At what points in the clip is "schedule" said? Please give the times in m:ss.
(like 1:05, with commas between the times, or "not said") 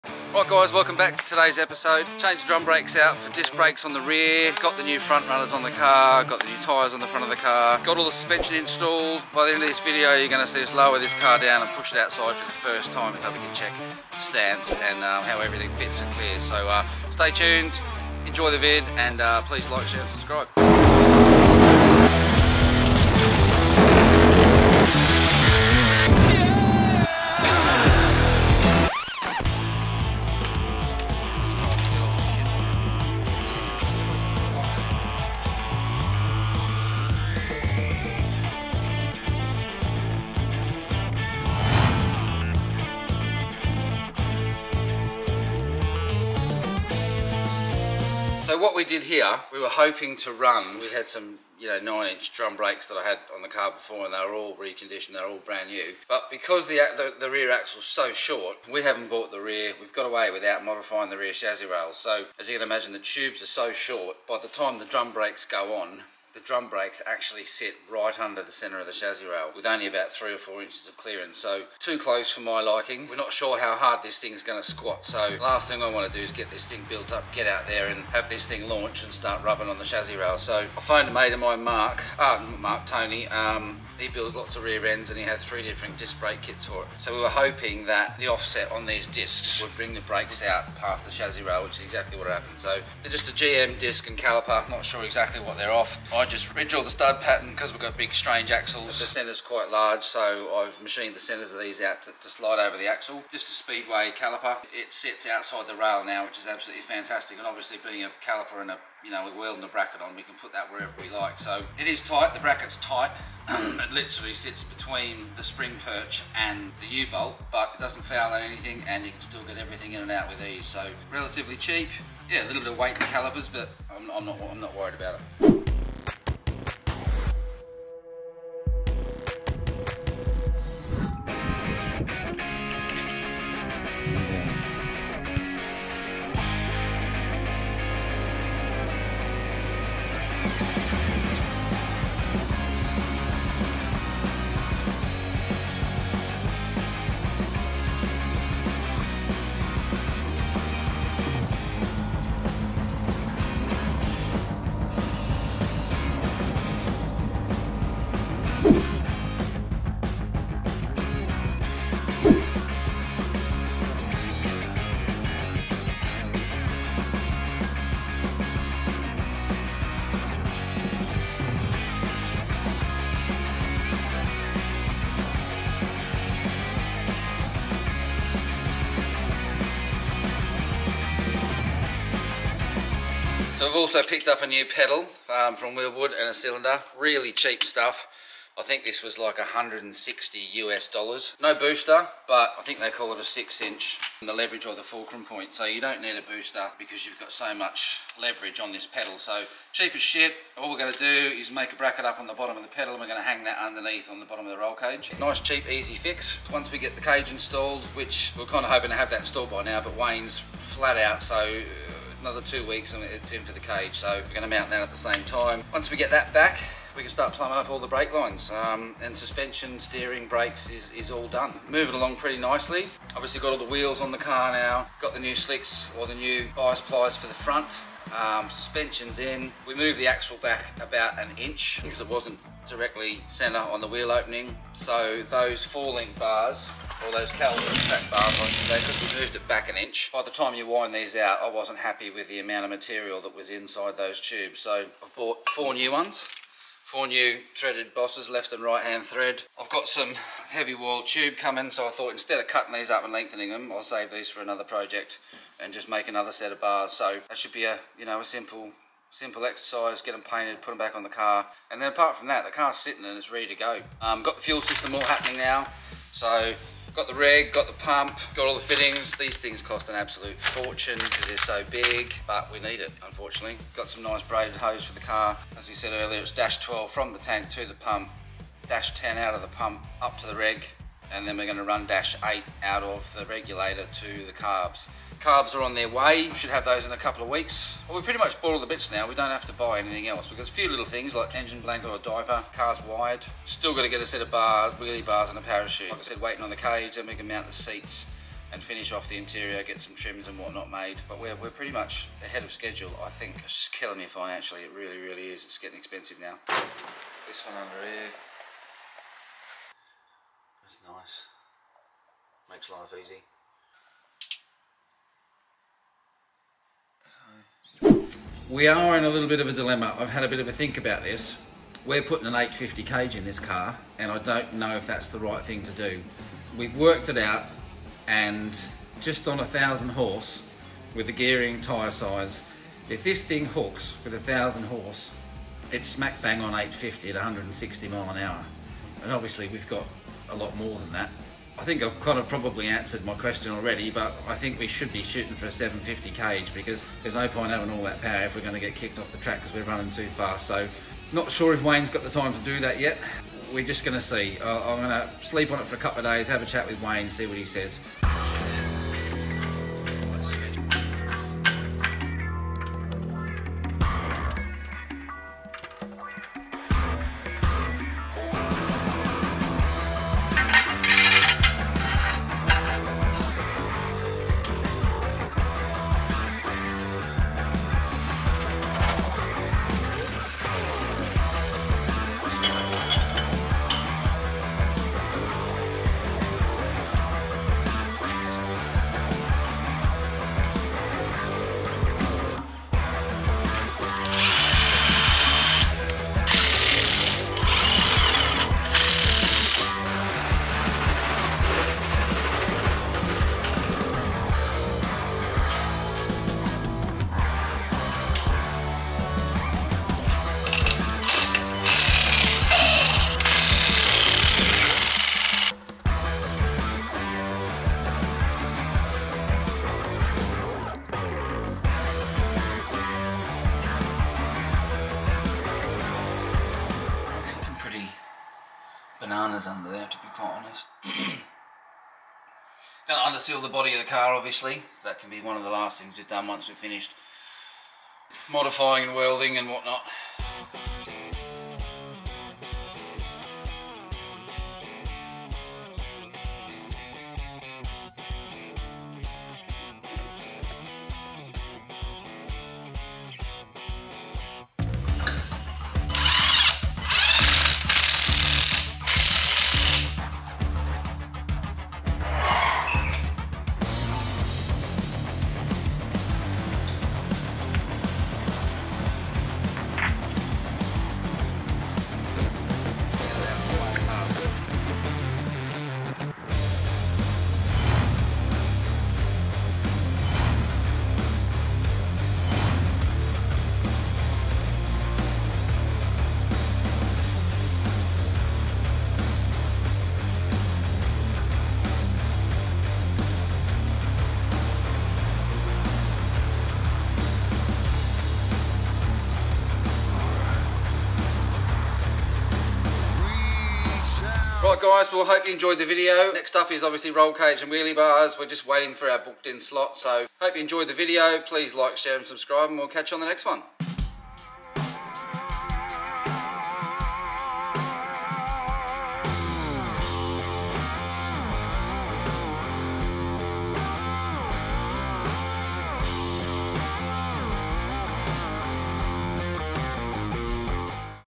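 5:02.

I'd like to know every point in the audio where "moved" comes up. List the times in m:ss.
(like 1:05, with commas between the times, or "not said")
3:49, 3:59.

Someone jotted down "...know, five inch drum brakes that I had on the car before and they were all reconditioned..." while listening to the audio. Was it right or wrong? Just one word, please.
wrong.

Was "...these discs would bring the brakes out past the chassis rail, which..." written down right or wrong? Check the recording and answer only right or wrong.
right.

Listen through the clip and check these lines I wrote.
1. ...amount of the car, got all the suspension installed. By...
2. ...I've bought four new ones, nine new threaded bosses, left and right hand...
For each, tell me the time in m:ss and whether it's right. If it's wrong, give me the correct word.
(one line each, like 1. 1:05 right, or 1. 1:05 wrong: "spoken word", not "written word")
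1. 0:07 wrong: "front", not "amount"
2. 4:05 wrong: "four", not "nine".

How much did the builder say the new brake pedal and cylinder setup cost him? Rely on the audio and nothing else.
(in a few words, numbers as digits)
160 US dollars.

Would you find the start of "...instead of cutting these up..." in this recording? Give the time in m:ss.
4:12.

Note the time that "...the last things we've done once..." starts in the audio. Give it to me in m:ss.
7:15.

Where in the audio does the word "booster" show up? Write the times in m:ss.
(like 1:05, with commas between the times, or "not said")
3:11, 3:16.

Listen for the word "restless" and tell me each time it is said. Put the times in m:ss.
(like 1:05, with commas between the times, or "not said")
not said.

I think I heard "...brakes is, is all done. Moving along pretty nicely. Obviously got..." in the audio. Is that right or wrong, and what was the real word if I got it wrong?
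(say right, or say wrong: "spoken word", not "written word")
right.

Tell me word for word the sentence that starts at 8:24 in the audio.
Right guys, well hope you enjoyed the video.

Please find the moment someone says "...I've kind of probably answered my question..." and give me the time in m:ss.
5:41.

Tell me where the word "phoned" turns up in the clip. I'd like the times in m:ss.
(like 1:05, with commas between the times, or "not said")
1:20.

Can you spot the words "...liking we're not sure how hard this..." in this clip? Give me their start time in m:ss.
1:12.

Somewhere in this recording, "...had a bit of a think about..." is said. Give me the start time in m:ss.
5:20.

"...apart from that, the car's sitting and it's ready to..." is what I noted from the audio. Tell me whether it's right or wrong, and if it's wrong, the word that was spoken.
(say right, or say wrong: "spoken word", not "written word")
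right.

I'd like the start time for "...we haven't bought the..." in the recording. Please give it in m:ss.
0:58.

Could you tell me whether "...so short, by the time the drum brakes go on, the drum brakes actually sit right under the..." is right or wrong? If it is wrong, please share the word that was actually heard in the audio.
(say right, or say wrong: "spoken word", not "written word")
right.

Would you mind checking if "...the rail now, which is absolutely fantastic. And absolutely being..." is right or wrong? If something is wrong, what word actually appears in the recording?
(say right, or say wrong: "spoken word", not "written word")
wrong: "obviously", not "absolutely".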